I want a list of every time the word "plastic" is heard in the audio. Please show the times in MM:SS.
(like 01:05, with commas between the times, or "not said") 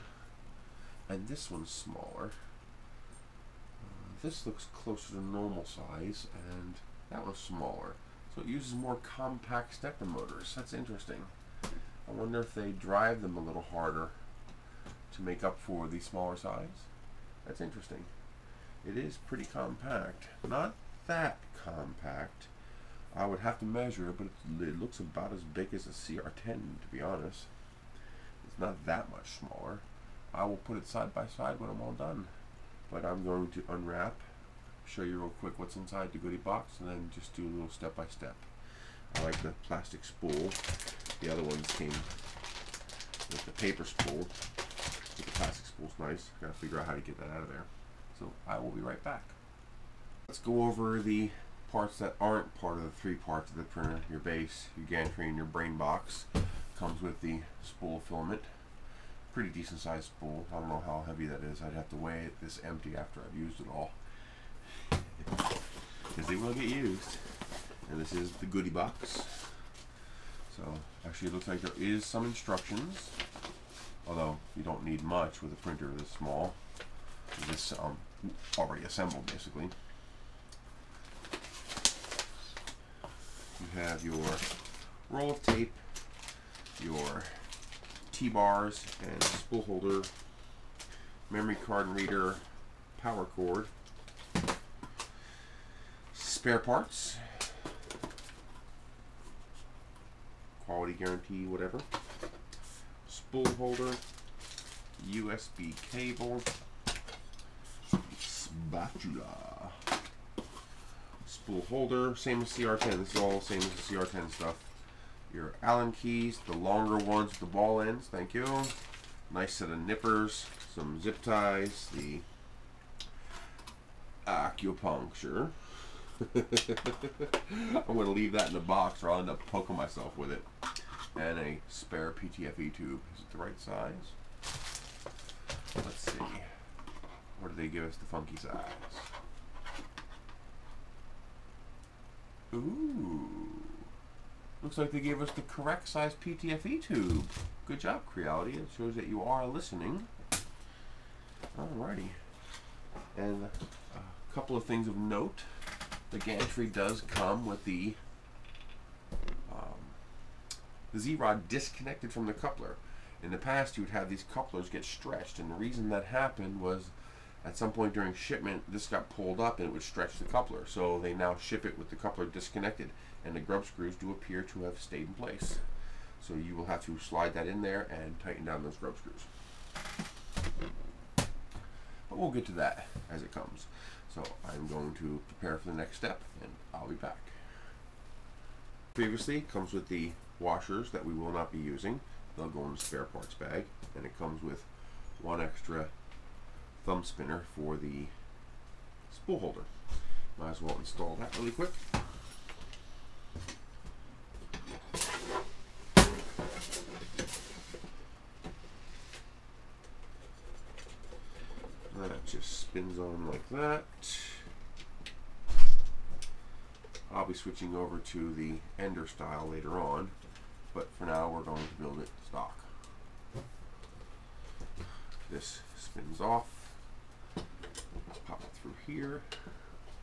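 00:39, 00:45.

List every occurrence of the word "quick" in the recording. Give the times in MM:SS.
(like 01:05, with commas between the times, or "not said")
00:35, 03:21.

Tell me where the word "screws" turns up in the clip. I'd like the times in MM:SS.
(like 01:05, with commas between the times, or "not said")
02:53, 02:58.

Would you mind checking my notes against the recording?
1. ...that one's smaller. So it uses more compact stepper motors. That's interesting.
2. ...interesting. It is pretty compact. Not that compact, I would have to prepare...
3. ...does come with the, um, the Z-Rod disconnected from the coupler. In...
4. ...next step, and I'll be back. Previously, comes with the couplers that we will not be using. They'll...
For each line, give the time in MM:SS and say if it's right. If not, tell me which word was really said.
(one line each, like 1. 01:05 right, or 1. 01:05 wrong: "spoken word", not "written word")
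1. 00:07 right
2. 00:17 wrong: "measure", not "prepare"
3. 02:36 right
4. 03:05 wrong: "washers", not "couplers".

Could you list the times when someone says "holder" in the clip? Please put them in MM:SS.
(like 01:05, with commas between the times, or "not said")
01:29, 01:43, 01:51, 03:19.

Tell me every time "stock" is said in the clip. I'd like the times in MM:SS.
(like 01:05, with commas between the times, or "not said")
03:42.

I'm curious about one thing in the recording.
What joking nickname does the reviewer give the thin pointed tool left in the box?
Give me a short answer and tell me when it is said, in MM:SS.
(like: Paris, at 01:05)
the acupuncture, at 02:01.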